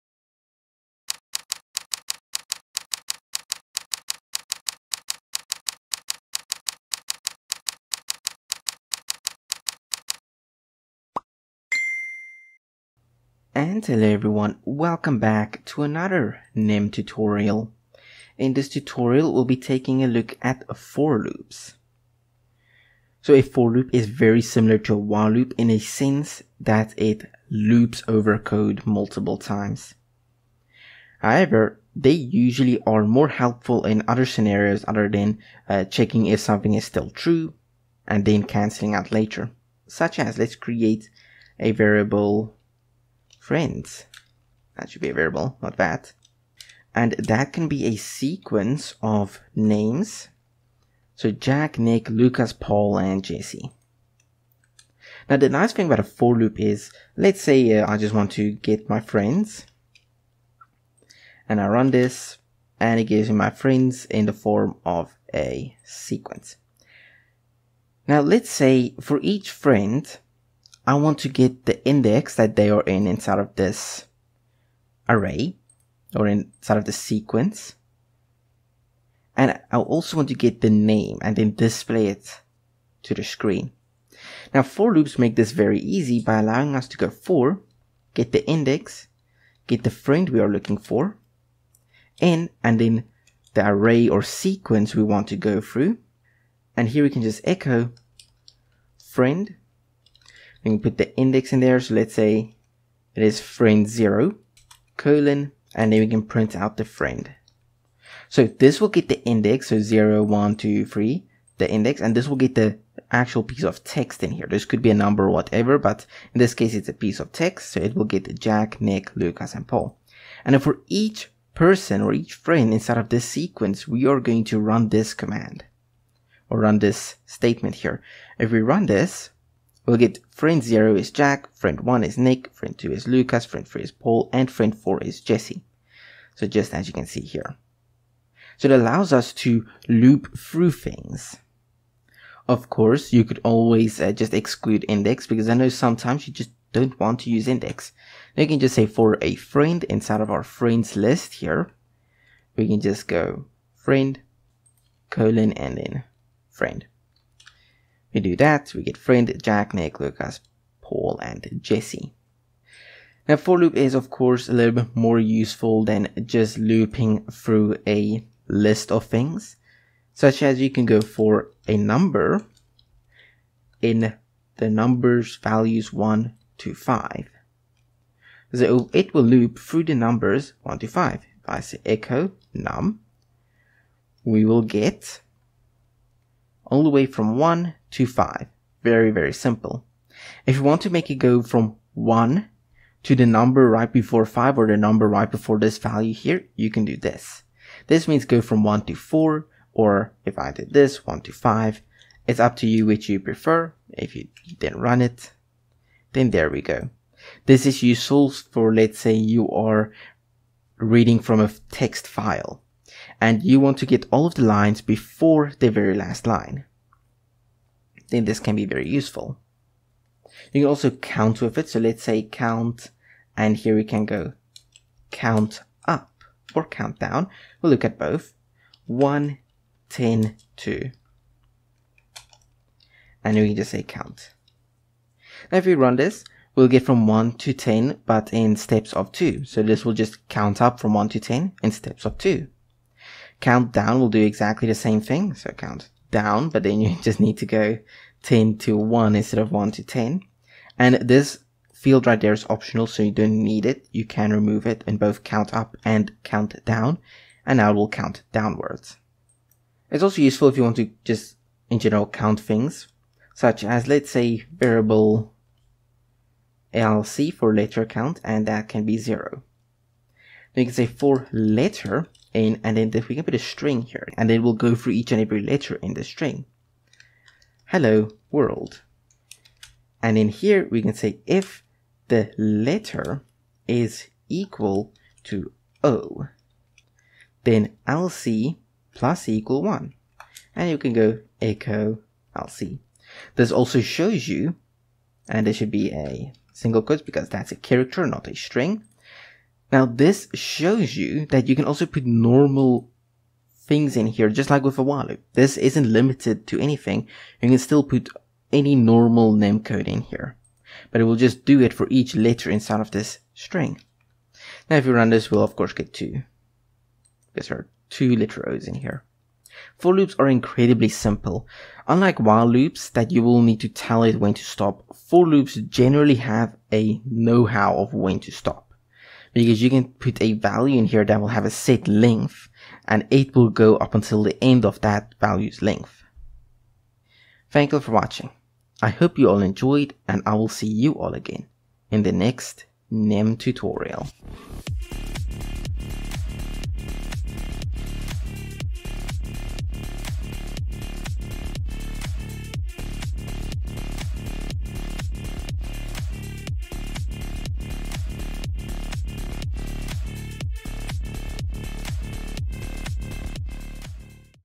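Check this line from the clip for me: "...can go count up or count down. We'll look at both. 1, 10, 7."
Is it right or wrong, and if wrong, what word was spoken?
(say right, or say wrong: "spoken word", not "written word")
wrong: "2", not "7".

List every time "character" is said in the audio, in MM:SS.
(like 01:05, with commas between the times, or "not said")
04:57.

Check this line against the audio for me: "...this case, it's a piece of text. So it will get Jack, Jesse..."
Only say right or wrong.
wrong.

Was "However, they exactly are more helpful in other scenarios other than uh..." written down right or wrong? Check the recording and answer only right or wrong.
wrong.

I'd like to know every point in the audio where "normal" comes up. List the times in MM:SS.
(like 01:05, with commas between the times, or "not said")
05:02, 05:08.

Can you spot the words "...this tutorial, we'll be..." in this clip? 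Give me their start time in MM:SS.
00:18.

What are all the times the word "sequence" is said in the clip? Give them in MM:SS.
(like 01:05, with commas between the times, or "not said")
00:47, 01:05, 01:16, 01:34, 02:03.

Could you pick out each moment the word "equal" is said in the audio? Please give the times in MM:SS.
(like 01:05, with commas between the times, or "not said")
04:44, 04:49.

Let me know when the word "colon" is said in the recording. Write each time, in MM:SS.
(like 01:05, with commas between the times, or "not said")
01:44, 02:35.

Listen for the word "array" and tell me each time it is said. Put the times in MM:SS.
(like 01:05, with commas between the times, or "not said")
01:15, 01:33.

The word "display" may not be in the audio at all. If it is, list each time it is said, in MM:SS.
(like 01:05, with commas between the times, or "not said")
01:21.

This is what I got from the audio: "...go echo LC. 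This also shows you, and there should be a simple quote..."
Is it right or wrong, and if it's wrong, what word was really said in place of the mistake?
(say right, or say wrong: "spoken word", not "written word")
wrong: "single", not "simple".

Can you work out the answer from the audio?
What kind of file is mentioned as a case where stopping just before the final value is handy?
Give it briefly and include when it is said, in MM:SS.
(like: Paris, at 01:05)
text file, at 03:31.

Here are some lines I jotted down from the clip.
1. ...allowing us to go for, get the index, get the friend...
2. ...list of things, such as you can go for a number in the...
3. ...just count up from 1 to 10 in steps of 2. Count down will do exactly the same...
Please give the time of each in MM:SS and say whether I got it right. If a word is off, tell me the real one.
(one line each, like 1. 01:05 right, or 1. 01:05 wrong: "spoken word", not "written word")
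1. 01:26 right
2. 02:48 right
3. 03:59 right.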